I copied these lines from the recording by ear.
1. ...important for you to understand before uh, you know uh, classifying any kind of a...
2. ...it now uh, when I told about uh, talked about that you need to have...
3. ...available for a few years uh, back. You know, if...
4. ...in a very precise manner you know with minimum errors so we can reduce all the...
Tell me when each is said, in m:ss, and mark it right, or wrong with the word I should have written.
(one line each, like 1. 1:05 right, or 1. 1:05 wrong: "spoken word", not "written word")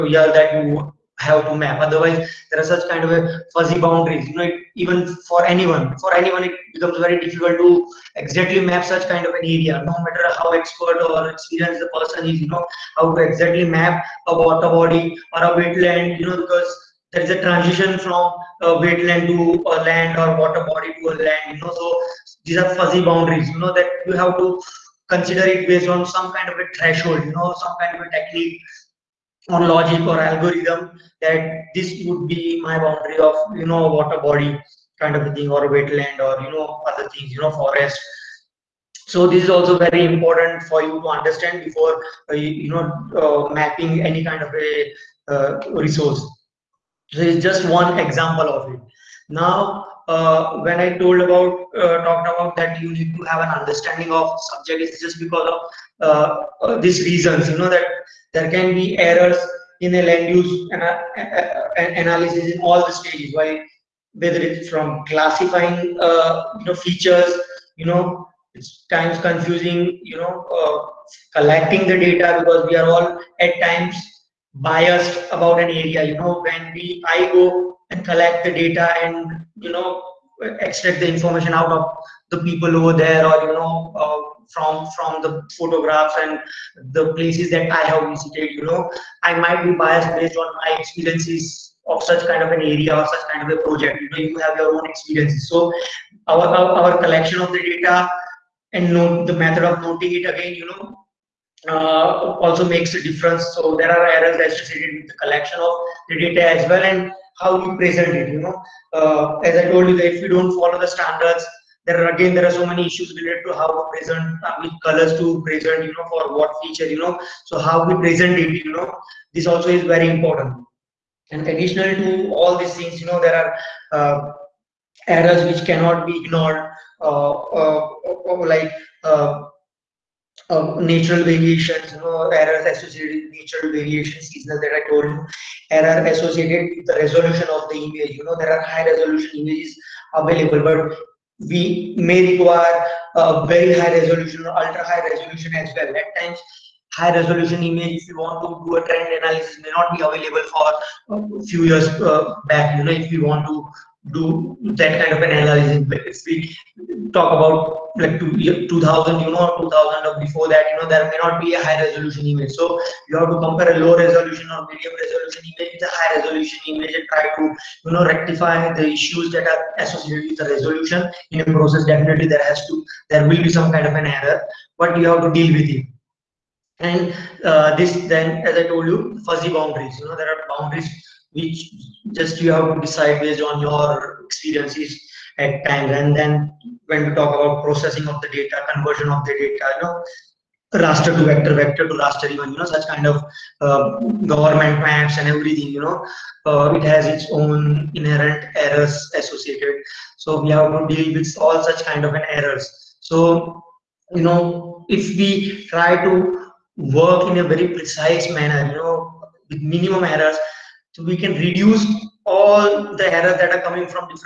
1. 0:40 wrong: "mapping", not "classifying"
2. 0:48 right
3. 2:30 right
4. 3:27 right.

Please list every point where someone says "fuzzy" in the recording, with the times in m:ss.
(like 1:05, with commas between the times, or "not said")
0:03, 0:22, 2:59.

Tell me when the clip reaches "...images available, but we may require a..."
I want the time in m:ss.
2:19.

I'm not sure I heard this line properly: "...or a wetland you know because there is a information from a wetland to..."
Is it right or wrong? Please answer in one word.
wrong.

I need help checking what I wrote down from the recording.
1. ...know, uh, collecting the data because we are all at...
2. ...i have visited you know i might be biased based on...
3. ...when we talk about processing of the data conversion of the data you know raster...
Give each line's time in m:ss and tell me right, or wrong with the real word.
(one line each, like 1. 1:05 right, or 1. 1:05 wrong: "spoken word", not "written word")
1. 1:10 right
2. 1:27 right
3. 3:06 right.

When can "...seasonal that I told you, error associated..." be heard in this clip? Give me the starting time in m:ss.
2:14.